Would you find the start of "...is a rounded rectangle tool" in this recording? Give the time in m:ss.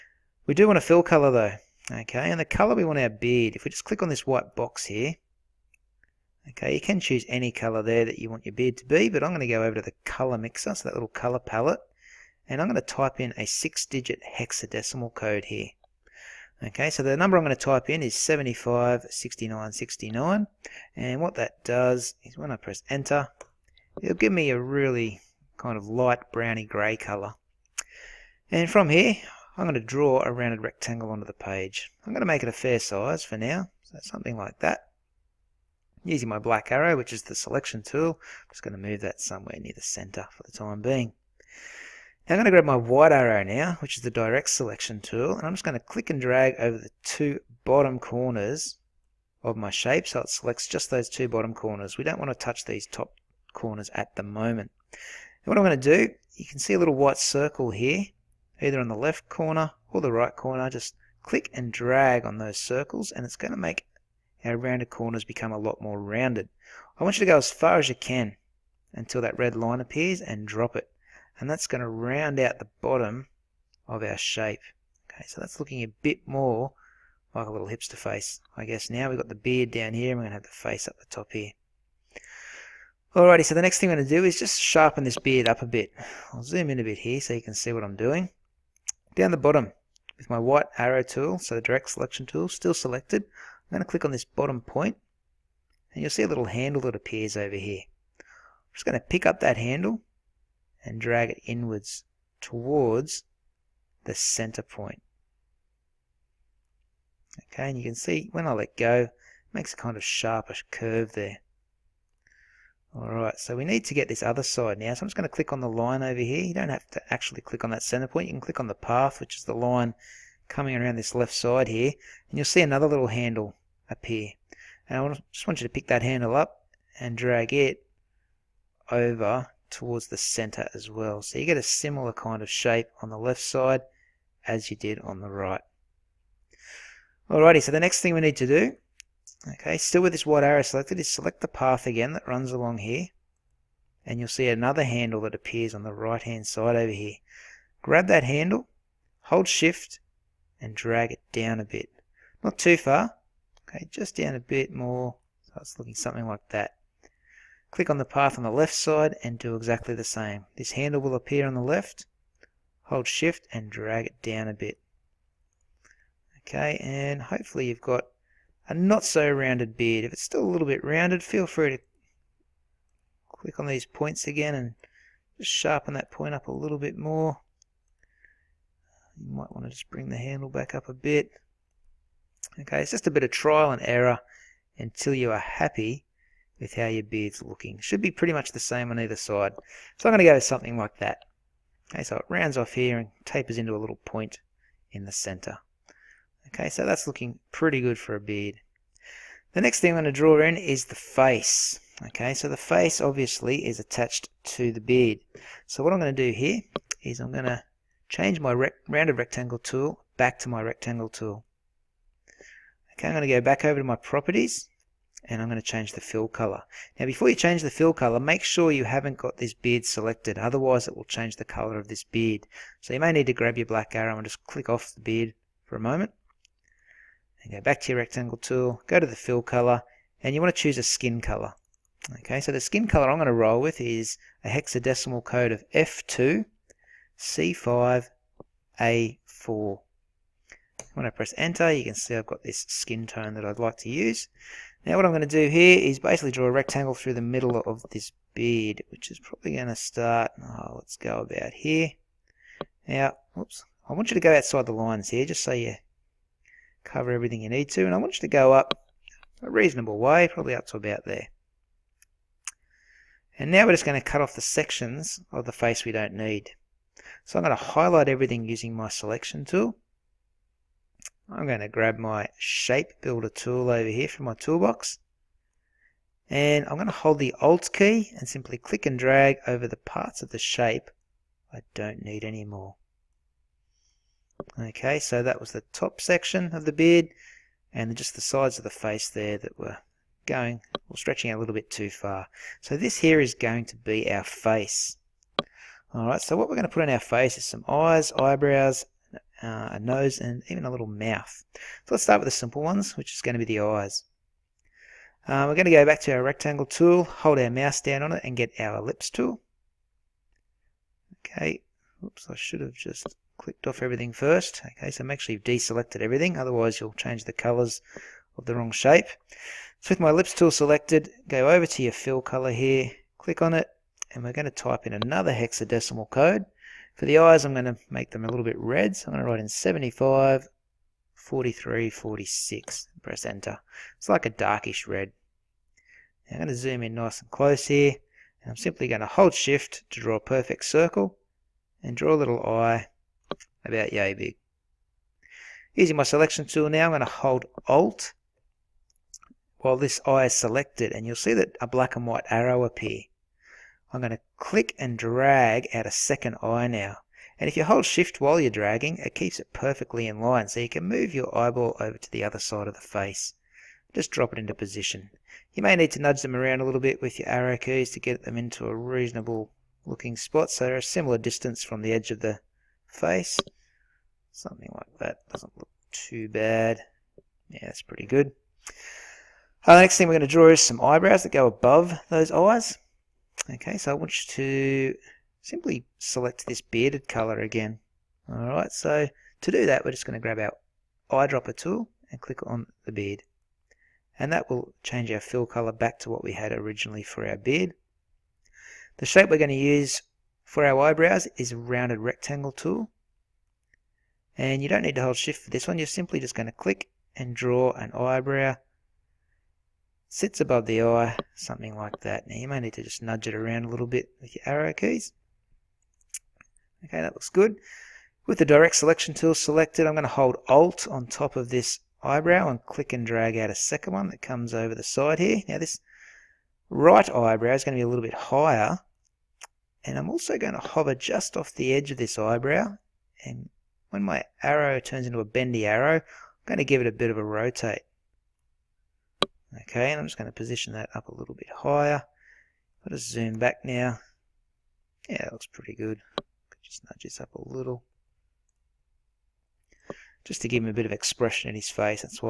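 6:41.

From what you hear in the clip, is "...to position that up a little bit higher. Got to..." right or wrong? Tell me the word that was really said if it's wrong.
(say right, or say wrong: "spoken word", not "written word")
right.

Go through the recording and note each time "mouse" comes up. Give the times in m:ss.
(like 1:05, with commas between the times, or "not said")
5:07.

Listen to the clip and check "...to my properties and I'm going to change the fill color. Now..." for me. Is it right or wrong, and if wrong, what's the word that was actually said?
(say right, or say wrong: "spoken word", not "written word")
right.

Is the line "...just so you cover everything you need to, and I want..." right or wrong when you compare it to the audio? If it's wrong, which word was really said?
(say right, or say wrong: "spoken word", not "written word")
right.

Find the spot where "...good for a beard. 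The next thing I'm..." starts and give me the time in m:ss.
3:17.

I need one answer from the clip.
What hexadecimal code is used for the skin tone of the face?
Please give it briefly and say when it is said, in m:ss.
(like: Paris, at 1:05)
F2C5A4, at 3:55.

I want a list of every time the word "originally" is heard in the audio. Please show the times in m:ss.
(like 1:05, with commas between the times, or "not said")
6:36.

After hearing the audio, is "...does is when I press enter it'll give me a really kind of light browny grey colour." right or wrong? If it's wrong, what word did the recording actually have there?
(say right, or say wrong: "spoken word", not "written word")
right.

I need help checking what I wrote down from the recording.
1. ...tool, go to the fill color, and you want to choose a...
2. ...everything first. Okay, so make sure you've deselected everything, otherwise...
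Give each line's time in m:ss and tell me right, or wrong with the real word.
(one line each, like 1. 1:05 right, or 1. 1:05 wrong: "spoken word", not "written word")
1. 3:48 right
2. 5:13 right.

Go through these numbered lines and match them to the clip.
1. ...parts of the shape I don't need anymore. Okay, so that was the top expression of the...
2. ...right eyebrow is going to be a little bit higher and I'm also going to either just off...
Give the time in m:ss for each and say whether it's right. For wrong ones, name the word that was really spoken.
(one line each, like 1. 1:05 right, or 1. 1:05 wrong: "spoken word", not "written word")
1. 4:39 wrong: "section", not "expression"
2. 7:06 wrong: "hover", not "either".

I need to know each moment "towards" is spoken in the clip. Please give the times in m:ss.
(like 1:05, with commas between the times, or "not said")
1:42, 2:09.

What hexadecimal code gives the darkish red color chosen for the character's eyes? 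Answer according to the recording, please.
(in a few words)
754346.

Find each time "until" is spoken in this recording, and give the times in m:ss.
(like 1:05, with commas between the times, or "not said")
1:08, 3:04.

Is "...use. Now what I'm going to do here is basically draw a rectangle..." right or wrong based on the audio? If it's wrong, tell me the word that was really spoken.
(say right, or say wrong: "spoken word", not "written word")
right.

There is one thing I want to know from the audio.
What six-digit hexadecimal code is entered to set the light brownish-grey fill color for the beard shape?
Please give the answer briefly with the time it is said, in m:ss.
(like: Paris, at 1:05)
756969, at 0:18.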